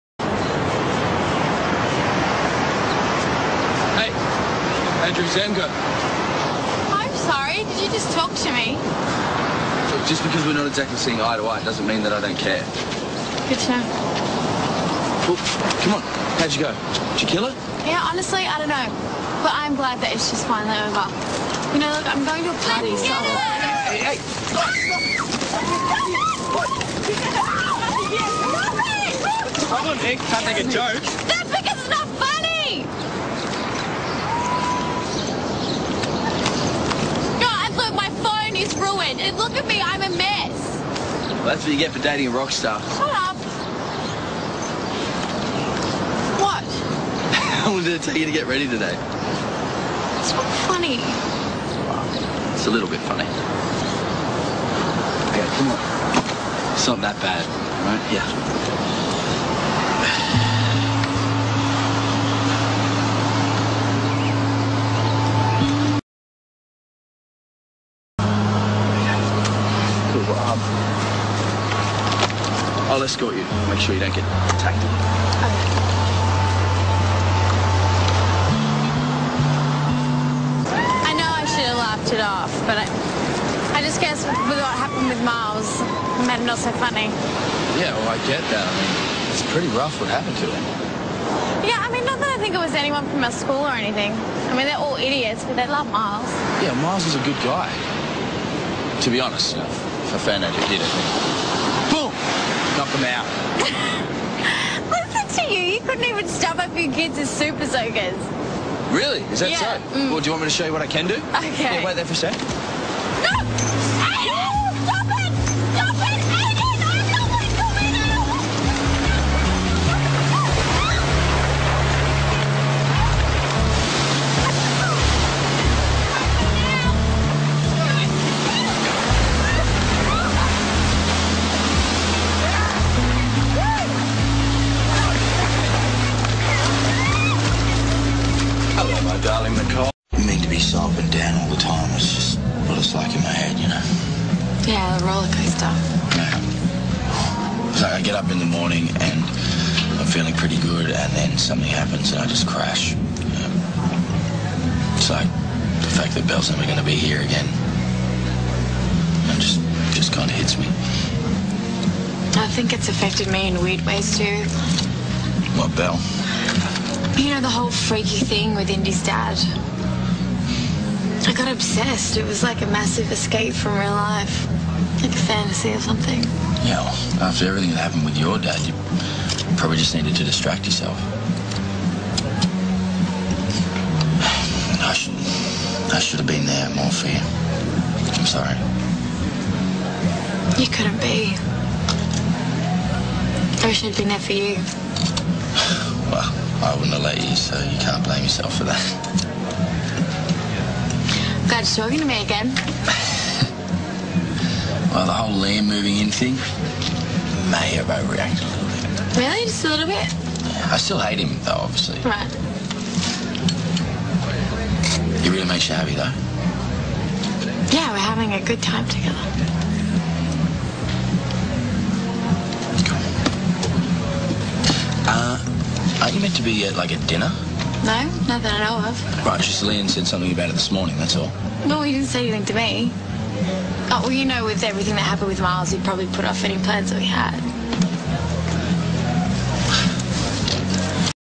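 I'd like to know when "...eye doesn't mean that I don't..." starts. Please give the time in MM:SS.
00:11.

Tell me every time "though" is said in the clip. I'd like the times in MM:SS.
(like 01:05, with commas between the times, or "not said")
03:31, 03:35.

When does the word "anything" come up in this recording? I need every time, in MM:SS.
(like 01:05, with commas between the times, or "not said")
01:33, 03:52.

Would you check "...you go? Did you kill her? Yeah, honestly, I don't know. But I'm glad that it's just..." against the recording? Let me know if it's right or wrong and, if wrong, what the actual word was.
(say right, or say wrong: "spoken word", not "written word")
right.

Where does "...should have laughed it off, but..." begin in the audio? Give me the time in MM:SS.
01:21.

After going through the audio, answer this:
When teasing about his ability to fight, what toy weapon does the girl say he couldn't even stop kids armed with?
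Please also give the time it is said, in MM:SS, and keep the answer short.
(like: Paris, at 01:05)
super soakers, at 01:47.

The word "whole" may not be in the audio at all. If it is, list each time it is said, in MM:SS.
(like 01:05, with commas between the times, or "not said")
02:47, 03:25.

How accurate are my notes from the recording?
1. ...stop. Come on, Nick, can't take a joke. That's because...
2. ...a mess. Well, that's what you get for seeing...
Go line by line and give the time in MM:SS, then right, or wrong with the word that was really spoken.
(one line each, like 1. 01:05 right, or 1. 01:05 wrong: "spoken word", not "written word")
1. 00:29 right
2. 00:40 wrong: "dating", not "seeing".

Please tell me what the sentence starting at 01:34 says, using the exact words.
I mean, they're all idiots, but they love Miles.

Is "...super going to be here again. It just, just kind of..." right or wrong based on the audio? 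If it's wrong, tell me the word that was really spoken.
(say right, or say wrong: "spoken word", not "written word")
wrong: "never", not "super".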